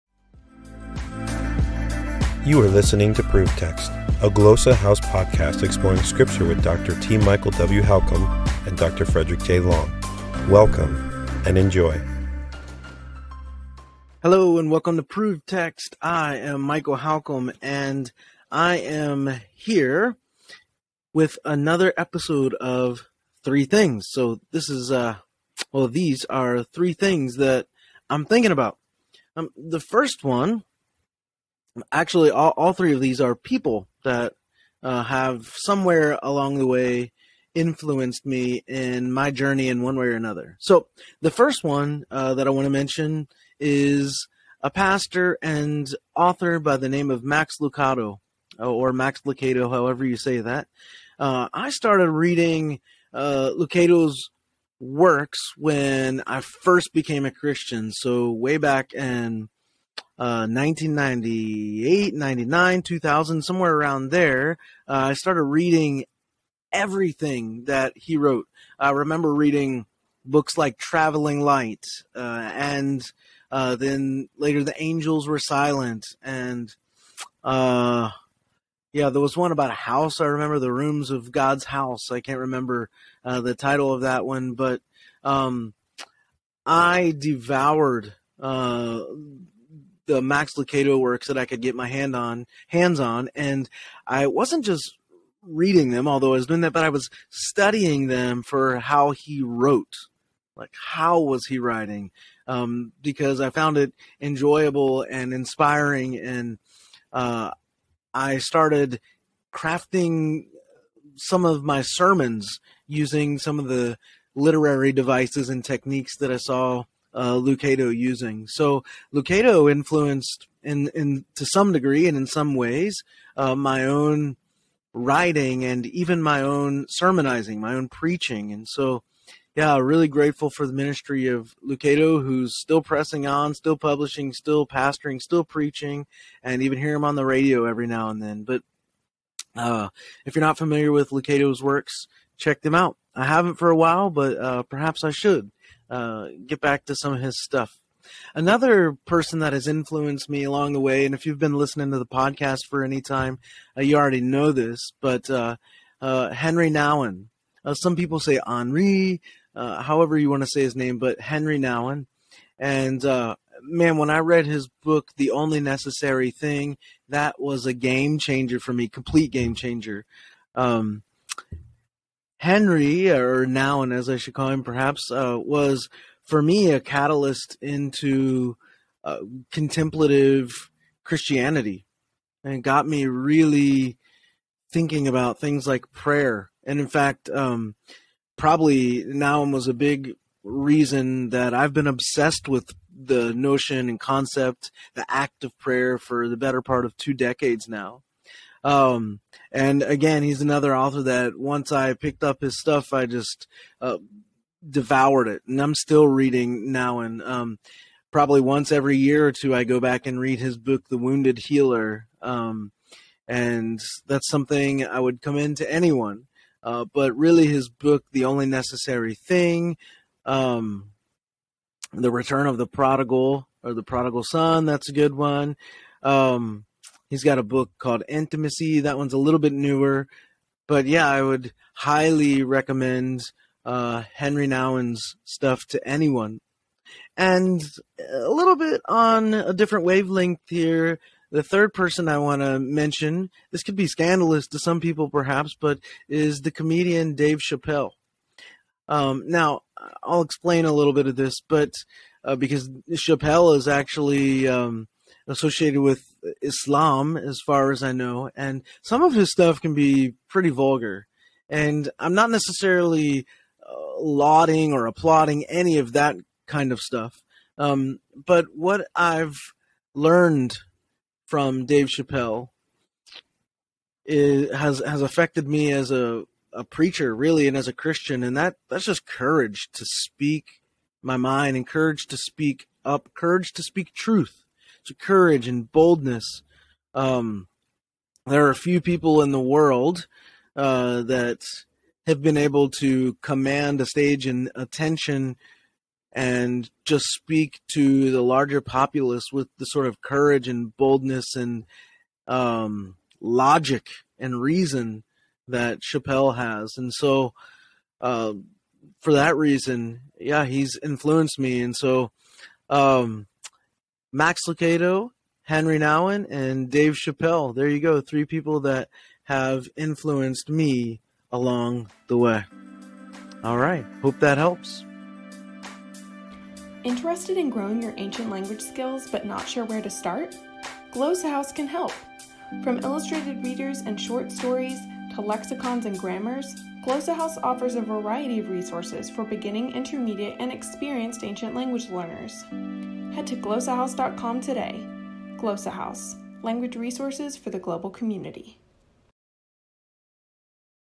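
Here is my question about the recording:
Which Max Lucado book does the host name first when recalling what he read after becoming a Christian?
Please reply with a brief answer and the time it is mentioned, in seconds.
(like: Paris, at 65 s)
Traveling Light, at 70 s.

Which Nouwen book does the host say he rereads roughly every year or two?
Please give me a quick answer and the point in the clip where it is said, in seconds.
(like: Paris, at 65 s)
The Wounded Healer, at 210 s.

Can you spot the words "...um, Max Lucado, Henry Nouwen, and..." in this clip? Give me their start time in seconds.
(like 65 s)
312 s.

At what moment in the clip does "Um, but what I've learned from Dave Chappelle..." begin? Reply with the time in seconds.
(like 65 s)
267 s.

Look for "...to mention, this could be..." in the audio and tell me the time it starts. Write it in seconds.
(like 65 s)
242 s.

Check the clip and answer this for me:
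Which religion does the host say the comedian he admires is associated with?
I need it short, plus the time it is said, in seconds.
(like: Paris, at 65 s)
Islam, at 256 s.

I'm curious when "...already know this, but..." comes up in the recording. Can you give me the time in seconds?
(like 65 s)
153 s.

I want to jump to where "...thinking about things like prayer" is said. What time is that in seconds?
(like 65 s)
184 s.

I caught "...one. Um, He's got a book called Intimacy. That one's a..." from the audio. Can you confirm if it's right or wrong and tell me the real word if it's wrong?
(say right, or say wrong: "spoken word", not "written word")
right.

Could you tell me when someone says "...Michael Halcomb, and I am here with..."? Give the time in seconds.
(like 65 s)
16 s.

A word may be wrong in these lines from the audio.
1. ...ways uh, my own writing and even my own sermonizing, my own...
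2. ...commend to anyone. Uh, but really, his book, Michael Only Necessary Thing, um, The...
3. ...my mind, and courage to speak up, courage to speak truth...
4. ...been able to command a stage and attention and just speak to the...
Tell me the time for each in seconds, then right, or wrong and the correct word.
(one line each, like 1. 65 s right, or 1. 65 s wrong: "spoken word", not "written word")
1. 122 s right
2. 215 s wrong: "The", not "Michael"
3. 281 s right
4. 292 s right.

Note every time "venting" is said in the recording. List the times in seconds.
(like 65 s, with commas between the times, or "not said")
not said.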